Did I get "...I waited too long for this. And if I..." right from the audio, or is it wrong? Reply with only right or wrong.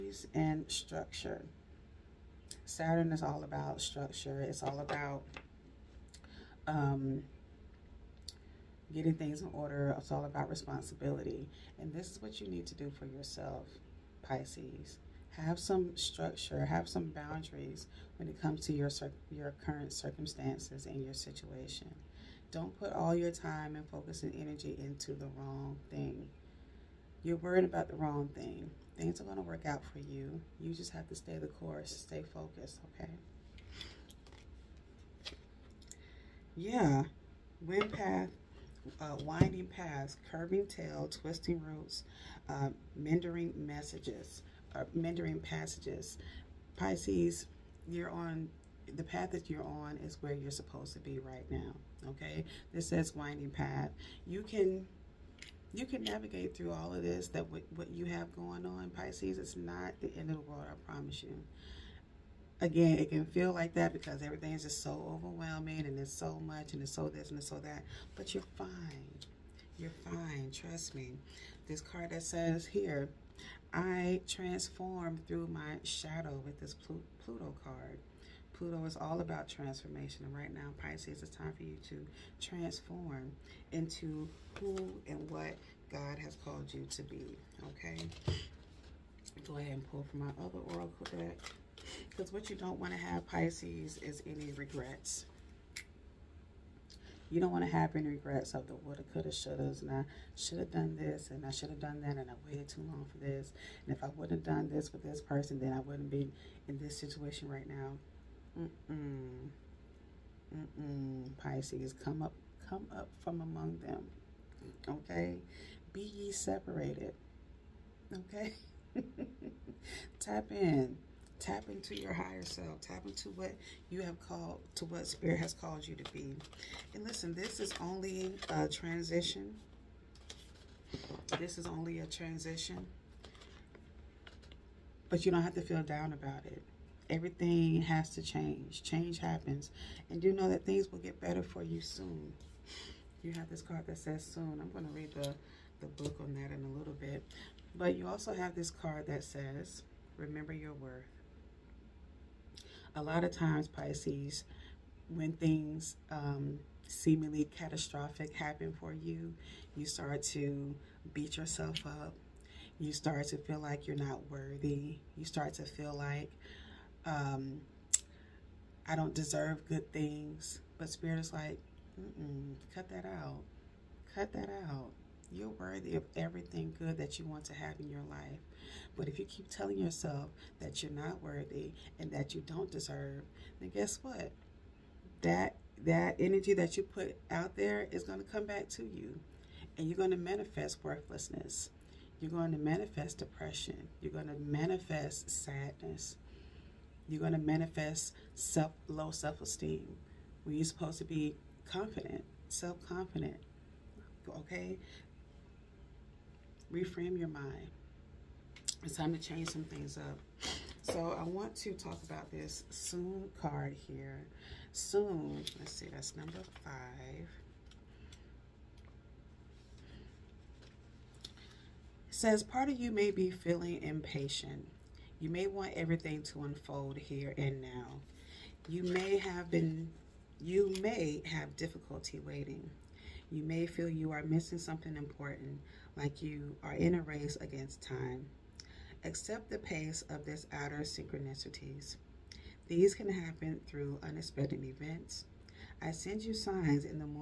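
right.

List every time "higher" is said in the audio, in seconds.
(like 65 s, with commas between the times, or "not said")
122 s.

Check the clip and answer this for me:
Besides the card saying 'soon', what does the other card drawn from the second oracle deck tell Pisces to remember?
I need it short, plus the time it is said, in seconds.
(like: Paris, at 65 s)
Remember your worth, at 150 s.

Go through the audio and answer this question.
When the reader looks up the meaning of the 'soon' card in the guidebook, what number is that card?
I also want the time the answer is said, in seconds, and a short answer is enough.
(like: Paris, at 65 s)
5, at 216 s.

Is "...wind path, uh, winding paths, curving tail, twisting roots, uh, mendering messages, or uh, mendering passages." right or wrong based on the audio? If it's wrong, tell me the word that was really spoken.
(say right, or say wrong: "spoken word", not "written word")
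right.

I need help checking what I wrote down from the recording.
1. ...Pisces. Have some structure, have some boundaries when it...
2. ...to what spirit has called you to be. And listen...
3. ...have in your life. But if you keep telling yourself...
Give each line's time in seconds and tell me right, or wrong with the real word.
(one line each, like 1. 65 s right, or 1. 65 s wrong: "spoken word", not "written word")
1. 14 s right
2. 124 s right
3. 177 s right.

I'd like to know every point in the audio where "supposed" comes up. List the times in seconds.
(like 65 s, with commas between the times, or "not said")
50 s, 200 s.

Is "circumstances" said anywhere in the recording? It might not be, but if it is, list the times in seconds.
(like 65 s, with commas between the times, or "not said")
19 s.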